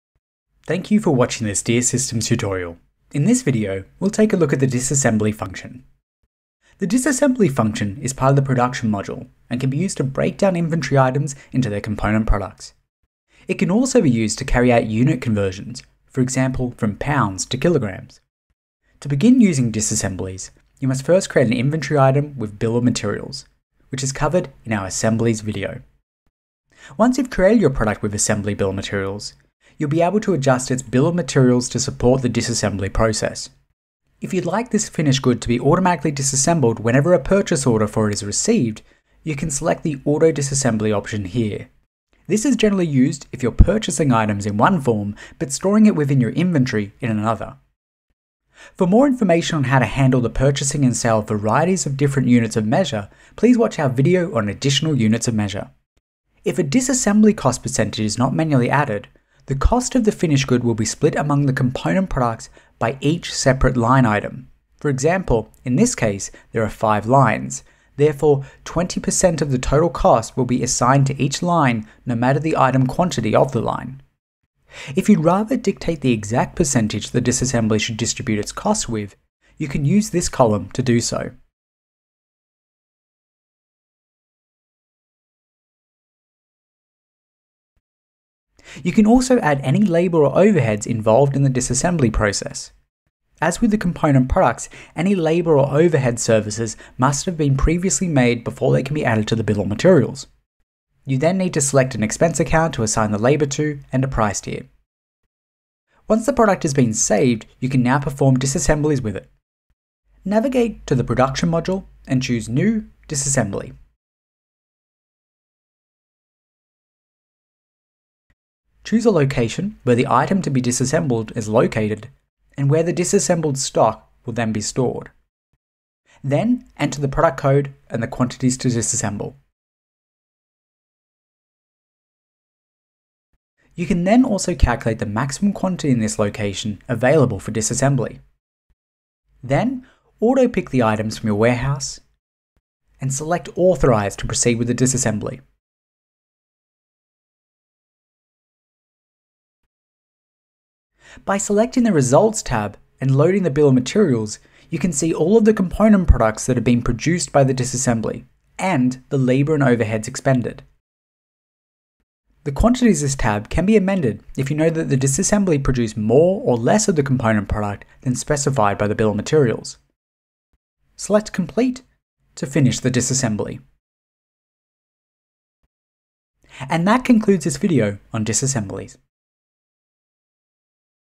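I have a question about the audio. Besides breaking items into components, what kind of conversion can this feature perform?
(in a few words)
unit conversions.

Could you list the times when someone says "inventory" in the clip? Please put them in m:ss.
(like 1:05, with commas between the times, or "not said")
0:10, 0:21, 0:46.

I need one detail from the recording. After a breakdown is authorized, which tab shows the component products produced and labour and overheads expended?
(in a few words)
Results.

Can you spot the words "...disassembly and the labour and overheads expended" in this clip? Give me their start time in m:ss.
2:37.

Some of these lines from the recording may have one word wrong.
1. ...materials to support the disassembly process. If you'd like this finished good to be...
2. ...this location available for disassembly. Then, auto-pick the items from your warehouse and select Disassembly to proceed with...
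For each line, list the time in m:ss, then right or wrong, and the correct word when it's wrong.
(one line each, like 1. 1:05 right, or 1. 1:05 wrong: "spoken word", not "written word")
1. 0:31 right
2. 2:15 wrong: "Authorize", not "Disassembly".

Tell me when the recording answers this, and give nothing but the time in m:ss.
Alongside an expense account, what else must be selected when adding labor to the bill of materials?
1:44.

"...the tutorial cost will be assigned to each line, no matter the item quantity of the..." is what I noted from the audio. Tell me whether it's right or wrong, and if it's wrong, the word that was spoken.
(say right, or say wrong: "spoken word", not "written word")
wrong: "total", not "tutorial".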